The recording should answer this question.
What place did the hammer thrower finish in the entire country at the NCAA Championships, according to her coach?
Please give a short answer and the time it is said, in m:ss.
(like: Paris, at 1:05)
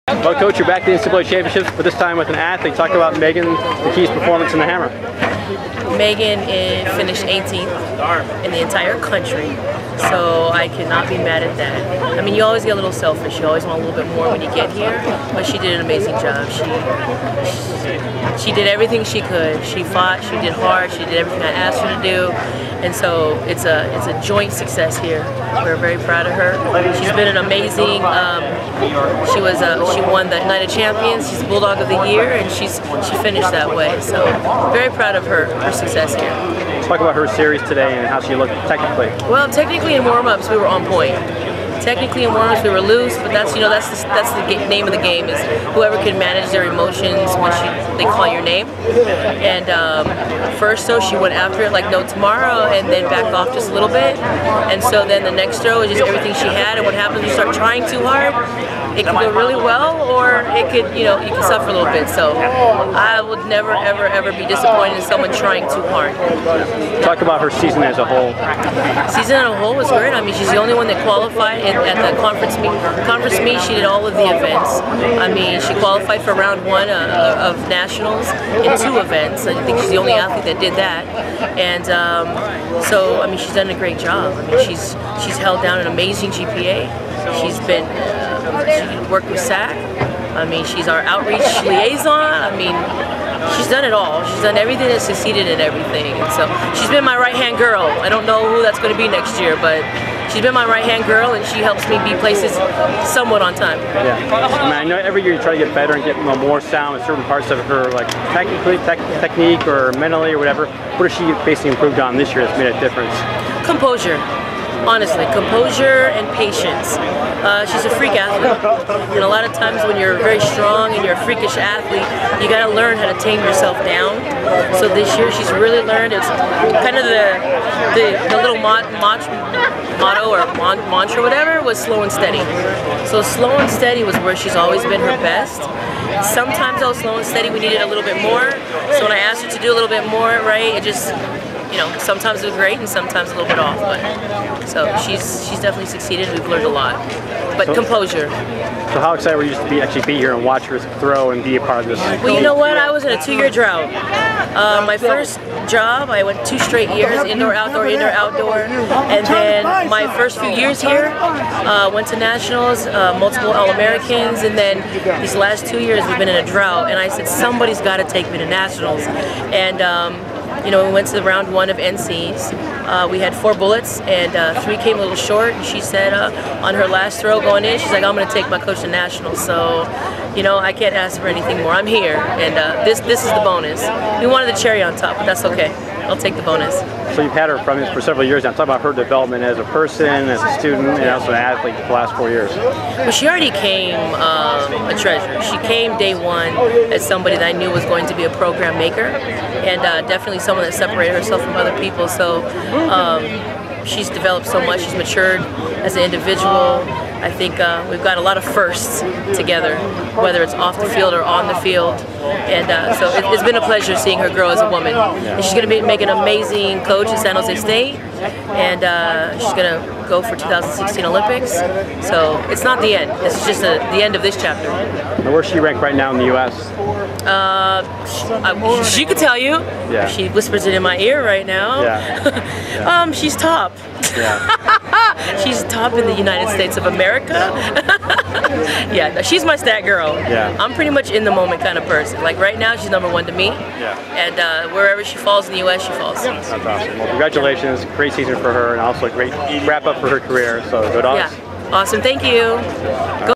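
18th, at 0:07.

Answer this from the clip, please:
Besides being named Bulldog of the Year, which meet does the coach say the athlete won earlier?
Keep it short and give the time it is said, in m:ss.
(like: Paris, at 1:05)
Night of Champions, at 0:30.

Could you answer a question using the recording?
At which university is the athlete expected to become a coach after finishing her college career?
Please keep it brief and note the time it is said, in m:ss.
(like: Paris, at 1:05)
San Jose State, at 3:37.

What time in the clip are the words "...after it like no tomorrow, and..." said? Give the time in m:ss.
0:51.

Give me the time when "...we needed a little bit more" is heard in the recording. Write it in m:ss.
2:17.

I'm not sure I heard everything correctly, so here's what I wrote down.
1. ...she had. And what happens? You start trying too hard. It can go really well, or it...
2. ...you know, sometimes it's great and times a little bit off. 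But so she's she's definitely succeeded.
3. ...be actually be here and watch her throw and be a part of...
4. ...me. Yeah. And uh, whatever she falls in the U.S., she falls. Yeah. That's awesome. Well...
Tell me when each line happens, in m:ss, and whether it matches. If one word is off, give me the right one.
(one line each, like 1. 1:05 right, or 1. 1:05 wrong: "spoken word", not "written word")
1. 0:56 right
2. 2:21 wrong: "sometimes", not "times"
3. 2:29 right
4. 4:03 wrong: "wherever", not "whatever".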